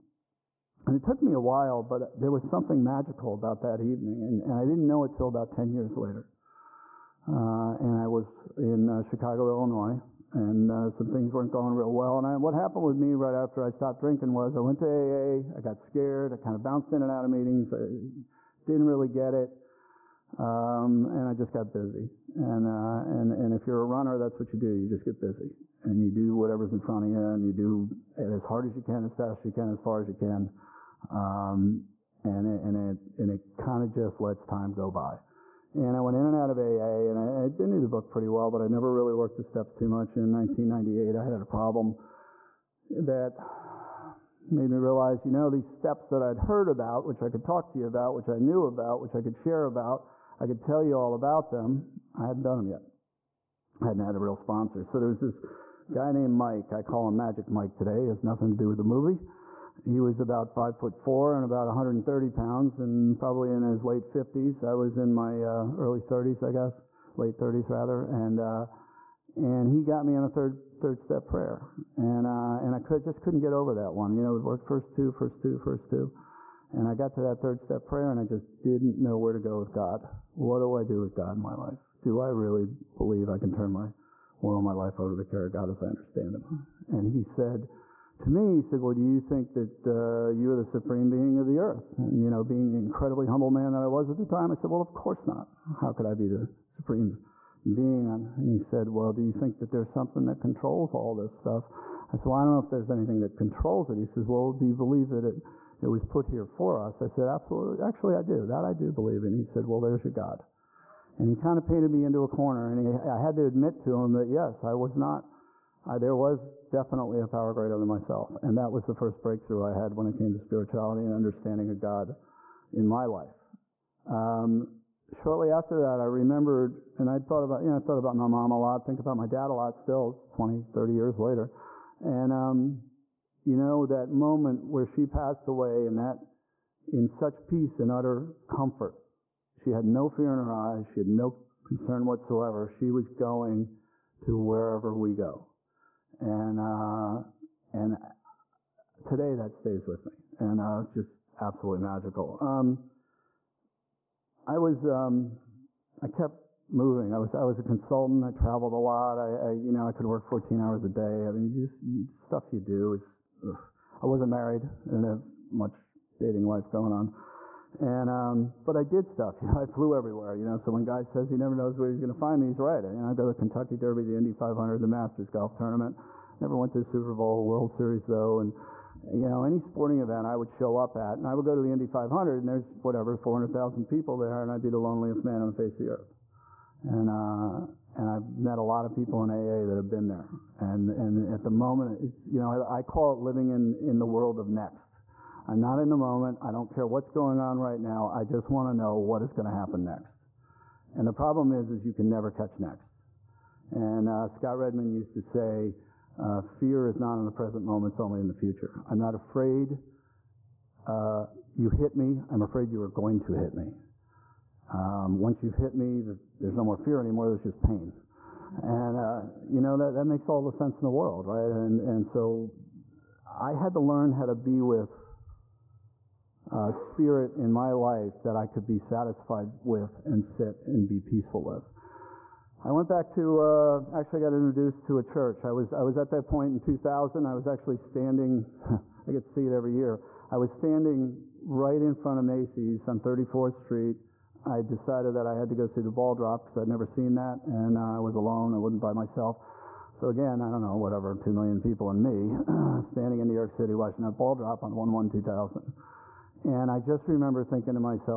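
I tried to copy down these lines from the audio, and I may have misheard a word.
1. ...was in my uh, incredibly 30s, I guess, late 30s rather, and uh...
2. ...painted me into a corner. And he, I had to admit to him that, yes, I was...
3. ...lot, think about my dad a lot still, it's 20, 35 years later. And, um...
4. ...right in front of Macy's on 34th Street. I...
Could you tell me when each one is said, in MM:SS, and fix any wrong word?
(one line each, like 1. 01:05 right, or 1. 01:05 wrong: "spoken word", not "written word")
1. 01:04 wrong: "early", not "incredibly"
2. 01:51 right
3. 02:08 wrong: "30", not "35"
4. 04:01 right.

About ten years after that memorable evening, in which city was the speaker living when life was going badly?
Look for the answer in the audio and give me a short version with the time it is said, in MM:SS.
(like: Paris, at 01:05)
Chicago, at 00:09.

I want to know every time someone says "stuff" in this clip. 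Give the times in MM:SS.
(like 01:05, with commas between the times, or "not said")
01:41, 02:42, 02:49.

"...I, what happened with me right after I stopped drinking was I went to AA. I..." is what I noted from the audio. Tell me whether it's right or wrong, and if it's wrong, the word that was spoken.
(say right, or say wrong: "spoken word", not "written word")
right.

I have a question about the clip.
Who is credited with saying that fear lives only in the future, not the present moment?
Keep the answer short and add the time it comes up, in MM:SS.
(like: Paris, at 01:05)
Scott Redmond, at 03:24.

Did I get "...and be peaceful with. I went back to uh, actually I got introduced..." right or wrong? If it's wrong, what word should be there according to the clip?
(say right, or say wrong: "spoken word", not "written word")
right.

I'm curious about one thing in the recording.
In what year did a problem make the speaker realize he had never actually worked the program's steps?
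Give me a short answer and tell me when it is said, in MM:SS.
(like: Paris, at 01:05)
1998, at 00:40.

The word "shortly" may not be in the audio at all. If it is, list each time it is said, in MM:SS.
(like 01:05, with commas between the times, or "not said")
02:05.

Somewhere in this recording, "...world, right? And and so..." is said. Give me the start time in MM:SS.
03:40.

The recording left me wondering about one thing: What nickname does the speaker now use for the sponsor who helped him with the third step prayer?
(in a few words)
Magic Mike.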